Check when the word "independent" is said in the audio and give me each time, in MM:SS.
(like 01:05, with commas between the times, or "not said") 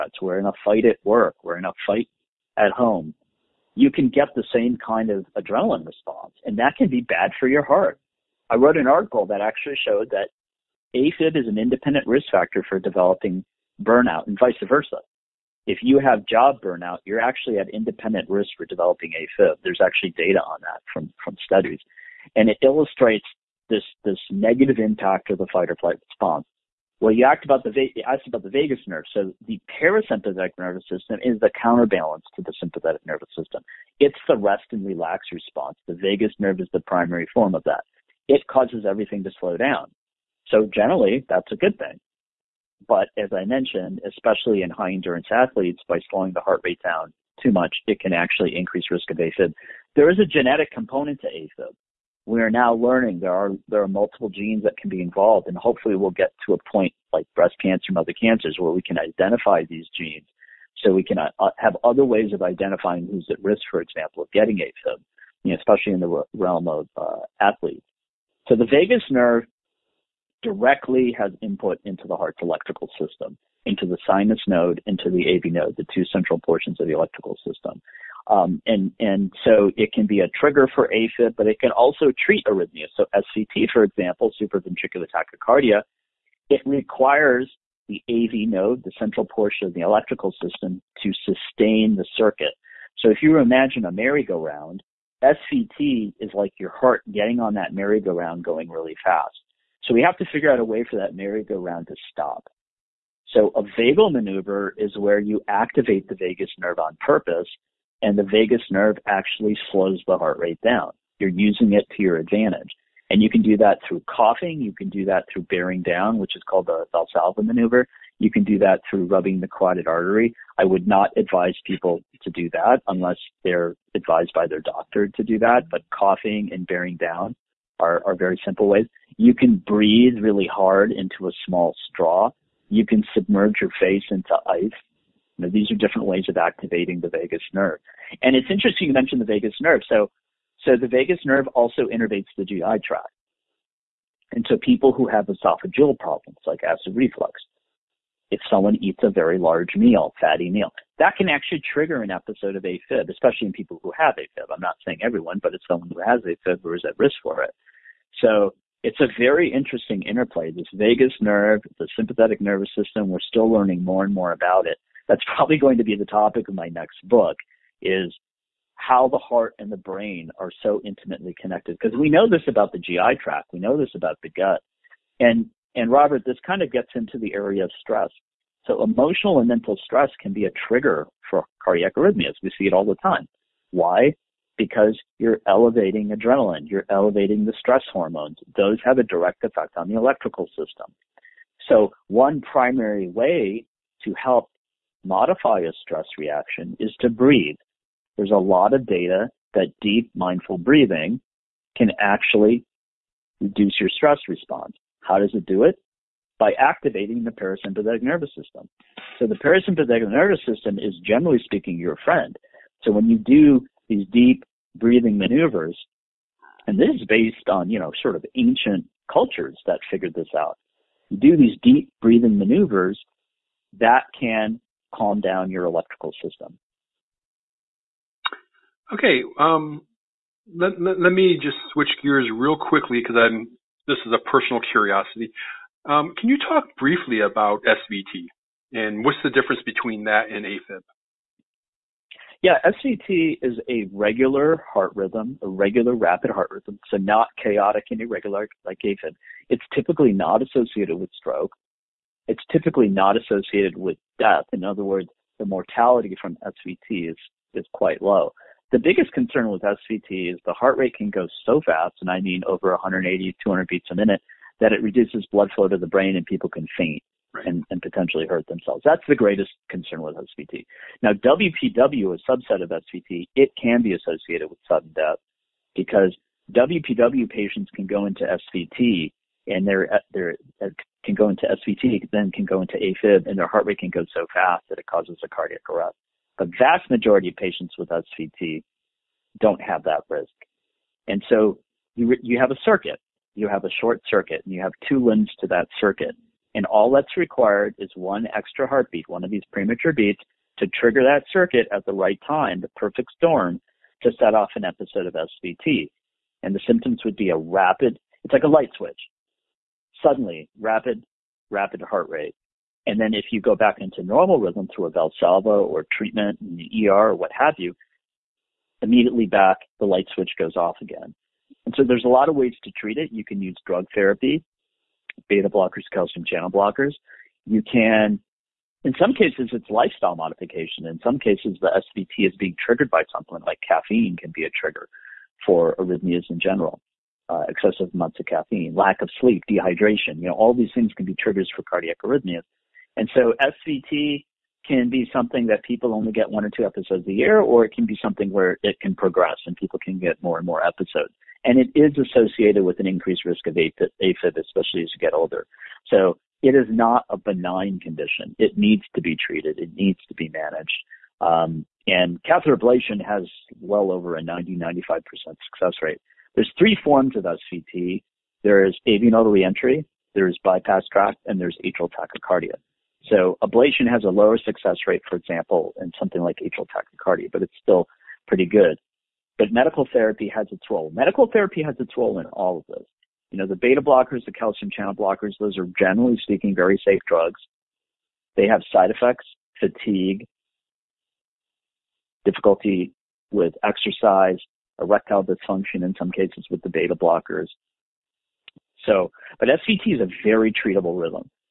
00:11, 00:17.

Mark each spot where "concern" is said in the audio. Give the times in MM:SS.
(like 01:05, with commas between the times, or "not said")
04:19, 04:29.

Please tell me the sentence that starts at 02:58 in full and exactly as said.
So emotional and mental stress can be a trigger for cardiac arrhythmias.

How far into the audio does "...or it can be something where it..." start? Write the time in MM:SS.
05:47.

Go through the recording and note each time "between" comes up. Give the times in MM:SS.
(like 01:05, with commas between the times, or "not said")
03:59.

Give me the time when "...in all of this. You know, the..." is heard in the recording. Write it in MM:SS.
06:22.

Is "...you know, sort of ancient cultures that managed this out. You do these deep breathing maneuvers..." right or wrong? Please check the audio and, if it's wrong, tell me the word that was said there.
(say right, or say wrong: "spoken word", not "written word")
wrong: "figured", not "managed".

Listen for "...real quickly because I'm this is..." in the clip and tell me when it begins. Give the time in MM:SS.
03:52.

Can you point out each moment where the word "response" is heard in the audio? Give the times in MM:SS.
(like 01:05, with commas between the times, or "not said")
00:05, 00:26, 00:35, 03:24.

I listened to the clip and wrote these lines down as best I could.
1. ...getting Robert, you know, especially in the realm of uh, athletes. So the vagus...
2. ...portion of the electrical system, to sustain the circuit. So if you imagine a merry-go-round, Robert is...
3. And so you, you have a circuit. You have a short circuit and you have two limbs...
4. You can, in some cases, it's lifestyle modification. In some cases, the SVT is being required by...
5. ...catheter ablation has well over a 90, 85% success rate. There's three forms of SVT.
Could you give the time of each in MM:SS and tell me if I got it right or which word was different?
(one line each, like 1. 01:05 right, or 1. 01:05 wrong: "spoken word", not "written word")
1. 01:04 wrong: "AFib", not "Robert"
2. 01:29 wrong: "SVT", not "Robert"
3. 04:51 right
4. 05:27 wrong: "triggered", not "required"
5. 06:02 wrong: "95", not "85".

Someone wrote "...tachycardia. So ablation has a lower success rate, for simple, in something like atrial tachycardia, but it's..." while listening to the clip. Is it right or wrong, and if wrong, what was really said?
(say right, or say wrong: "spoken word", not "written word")
wrong: "example", not "simple".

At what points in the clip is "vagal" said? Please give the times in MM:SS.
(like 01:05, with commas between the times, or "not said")
01:43.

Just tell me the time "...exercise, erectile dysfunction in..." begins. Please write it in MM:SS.
06:33.